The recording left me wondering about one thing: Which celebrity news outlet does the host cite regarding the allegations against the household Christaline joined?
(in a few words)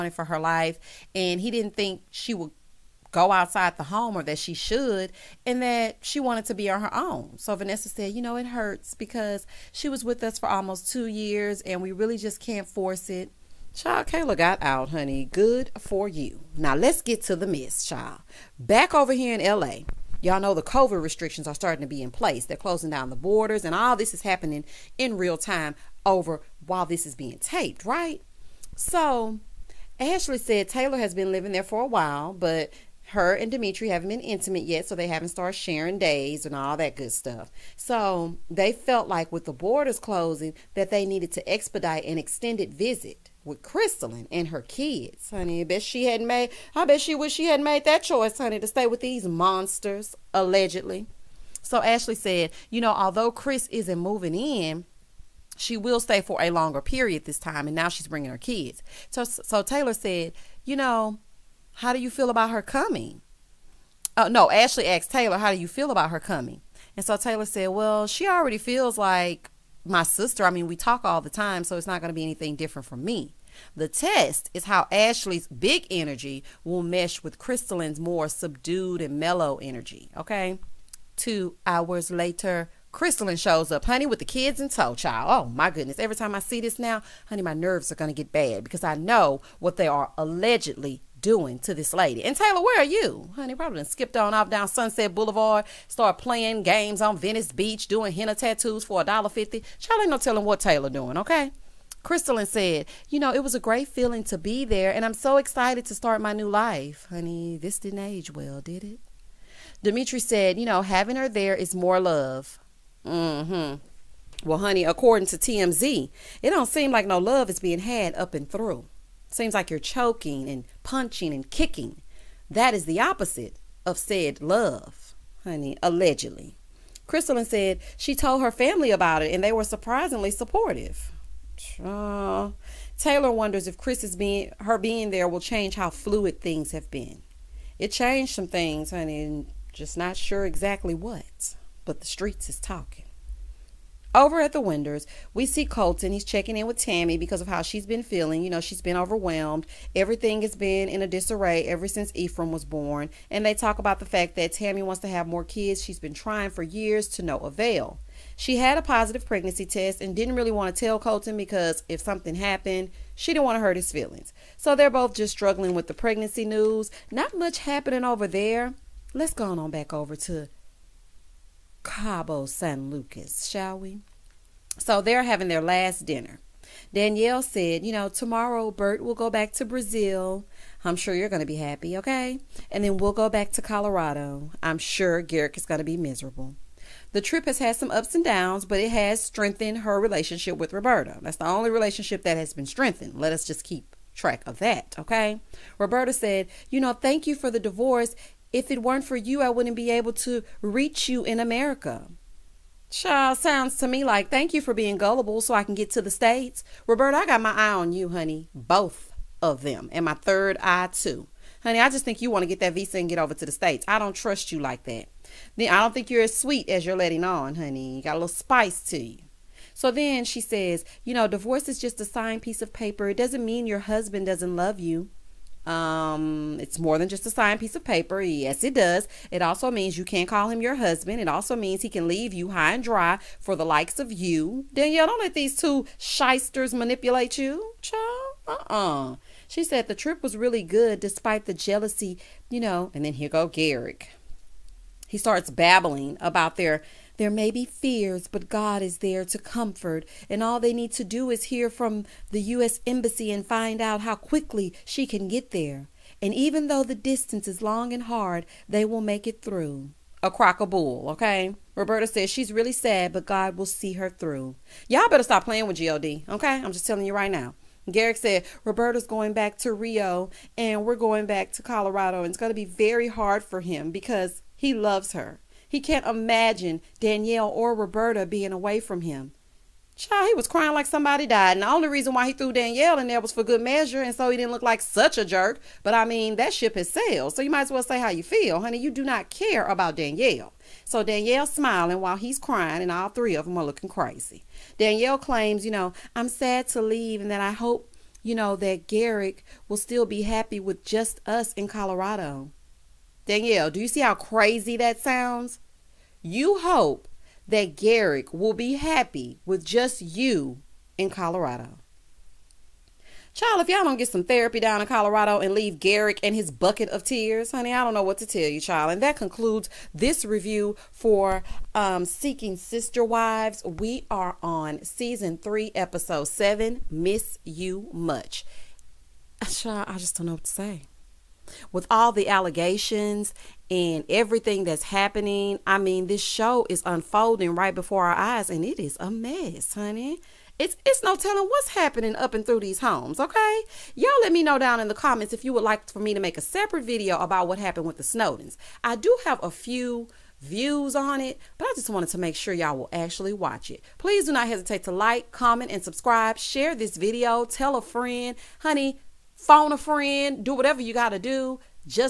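TMZ.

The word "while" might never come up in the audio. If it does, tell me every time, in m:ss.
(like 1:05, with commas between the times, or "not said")
0:26, 0:31, 4:51.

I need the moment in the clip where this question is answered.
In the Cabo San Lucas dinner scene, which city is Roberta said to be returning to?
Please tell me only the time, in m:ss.
4:29.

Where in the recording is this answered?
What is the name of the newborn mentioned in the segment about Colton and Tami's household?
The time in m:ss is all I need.
2:32.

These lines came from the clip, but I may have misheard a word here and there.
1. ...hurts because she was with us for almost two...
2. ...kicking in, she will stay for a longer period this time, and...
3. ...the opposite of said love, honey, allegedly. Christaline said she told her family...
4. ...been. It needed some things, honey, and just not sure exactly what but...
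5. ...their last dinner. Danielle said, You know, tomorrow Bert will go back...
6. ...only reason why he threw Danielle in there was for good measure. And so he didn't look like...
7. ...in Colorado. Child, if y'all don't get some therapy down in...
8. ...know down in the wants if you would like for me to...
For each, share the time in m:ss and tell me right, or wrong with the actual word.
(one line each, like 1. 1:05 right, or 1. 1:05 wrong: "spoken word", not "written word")
1. 0:08 right
2. 0:53 wrong: "moving", not "kicking"
3. 2:02 right
4. 2:16 wrong: "changed", not "needed"
5. 2:55 right
6. 4:41 right
7. 5:10 right
8. 5:44 wrong: "comments", not "wants".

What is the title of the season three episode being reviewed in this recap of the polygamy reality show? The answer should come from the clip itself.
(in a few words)
Miss You Much.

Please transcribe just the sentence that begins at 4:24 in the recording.
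Y'all better stop playing with GOD, okay?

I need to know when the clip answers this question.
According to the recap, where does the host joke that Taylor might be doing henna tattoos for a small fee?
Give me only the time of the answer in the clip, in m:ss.
1:37.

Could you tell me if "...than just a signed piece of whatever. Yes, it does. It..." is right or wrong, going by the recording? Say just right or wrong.
wrong.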